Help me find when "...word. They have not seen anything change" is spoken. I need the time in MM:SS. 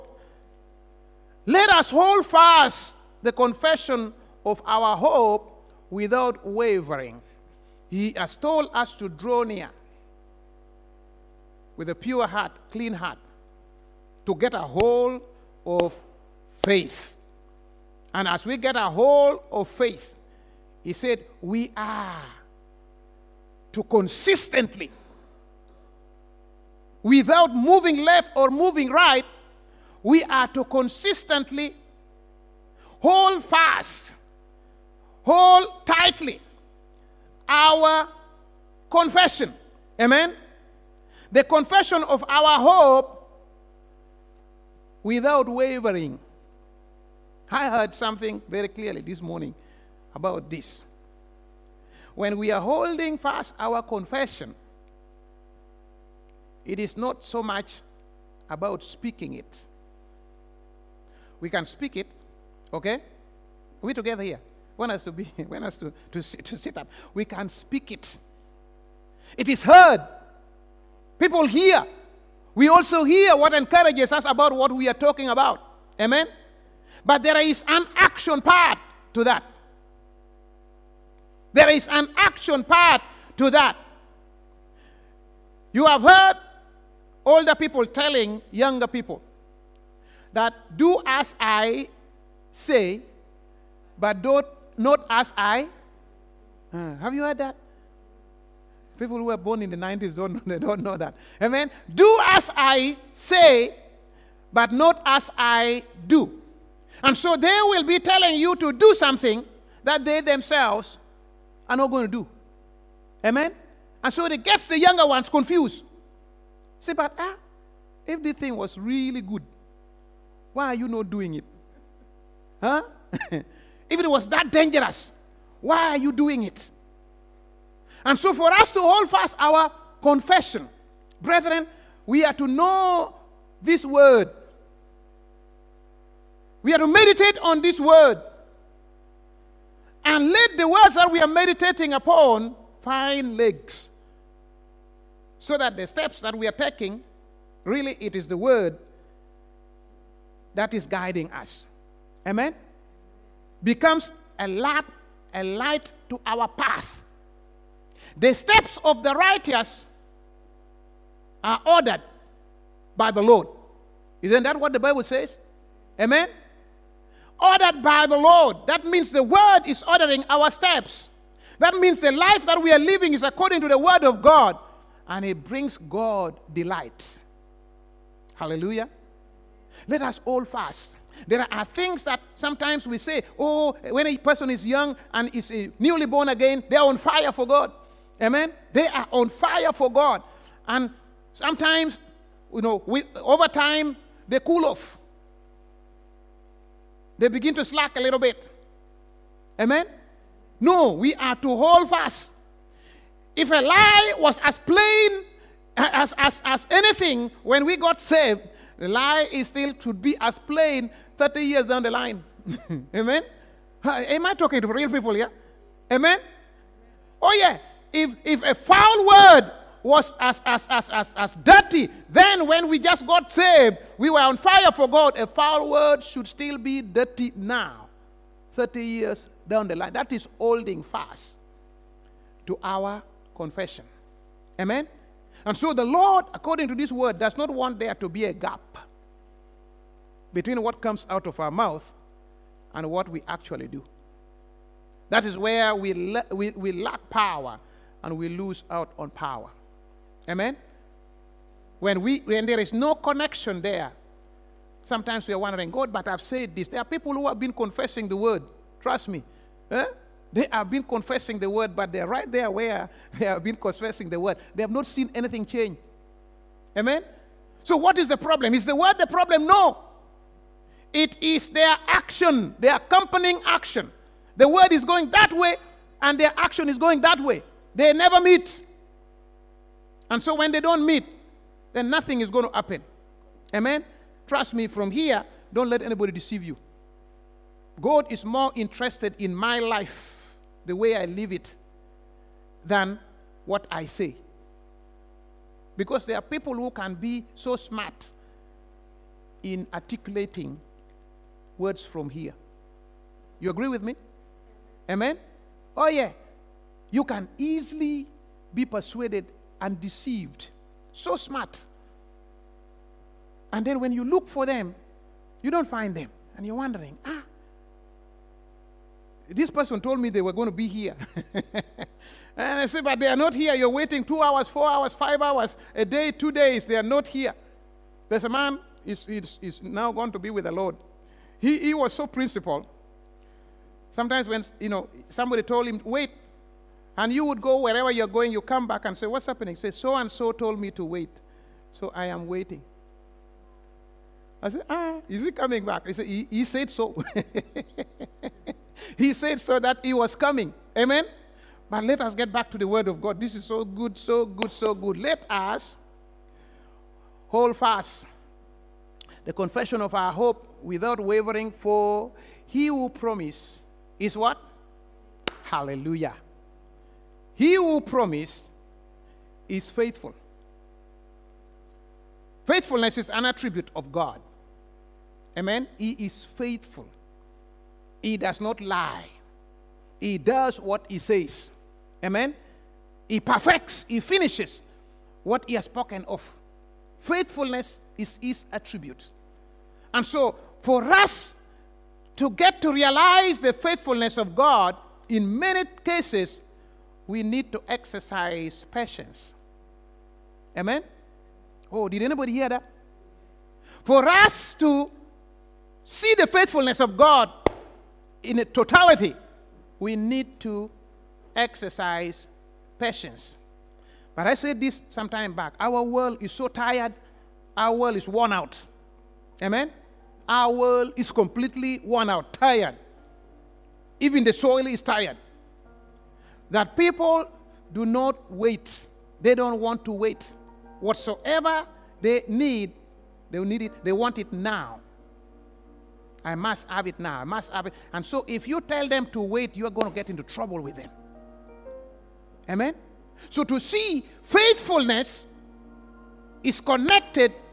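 04:24.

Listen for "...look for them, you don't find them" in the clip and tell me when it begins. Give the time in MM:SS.
05:14.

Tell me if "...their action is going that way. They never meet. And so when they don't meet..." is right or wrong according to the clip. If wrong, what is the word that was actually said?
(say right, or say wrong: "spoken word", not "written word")
right.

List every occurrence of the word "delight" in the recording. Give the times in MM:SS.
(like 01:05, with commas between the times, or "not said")
02:56.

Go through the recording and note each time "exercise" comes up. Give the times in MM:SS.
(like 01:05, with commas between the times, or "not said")
06:37, 06:51.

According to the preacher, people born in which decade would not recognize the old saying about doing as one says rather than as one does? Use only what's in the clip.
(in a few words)
the 90s.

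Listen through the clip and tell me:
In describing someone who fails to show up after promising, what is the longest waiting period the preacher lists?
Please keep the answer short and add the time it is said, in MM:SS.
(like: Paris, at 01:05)
two days, at 05:26.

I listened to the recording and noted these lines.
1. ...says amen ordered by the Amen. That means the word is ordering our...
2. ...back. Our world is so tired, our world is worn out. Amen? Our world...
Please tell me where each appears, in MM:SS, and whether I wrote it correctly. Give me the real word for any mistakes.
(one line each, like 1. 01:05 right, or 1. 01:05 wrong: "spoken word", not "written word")
1. 02:45 wrong: "Lord", not "Amen"
2. 06:55 right.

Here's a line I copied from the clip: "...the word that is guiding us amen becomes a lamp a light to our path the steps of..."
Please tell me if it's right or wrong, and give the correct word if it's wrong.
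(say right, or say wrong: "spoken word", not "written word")
right.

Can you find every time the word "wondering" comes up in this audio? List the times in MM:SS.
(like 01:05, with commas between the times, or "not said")
04:15, 05:16.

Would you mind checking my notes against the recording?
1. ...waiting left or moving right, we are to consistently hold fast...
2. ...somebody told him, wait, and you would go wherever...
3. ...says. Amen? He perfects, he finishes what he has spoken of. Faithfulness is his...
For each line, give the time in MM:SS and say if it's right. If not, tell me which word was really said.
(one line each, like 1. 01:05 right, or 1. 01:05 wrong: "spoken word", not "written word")
1. 00:27 wrong: "moving", not "waiting"
2. 05:35 right
3. 06:20 right.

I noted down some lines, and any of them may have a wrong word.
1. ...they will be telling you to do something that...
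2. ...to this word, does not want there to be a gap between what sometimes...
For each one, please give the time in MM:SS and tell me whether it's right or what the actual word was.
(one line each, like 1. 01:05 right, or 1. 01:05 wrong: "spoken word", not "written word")
1. 01:47 right
2. 03:56 wrong: "comes", not "sometimes".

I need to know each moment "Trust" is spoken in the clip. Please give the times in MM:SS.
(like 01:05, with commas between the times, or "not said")
04:18, 04:44.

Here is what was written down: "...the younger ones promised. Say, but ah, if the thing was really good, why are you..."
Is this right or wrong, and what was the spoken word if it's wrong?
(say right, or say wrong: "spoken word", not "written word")
wrong: "confused", not "promised".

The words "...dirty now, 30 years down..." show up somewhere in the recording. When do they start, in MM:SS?
03:46.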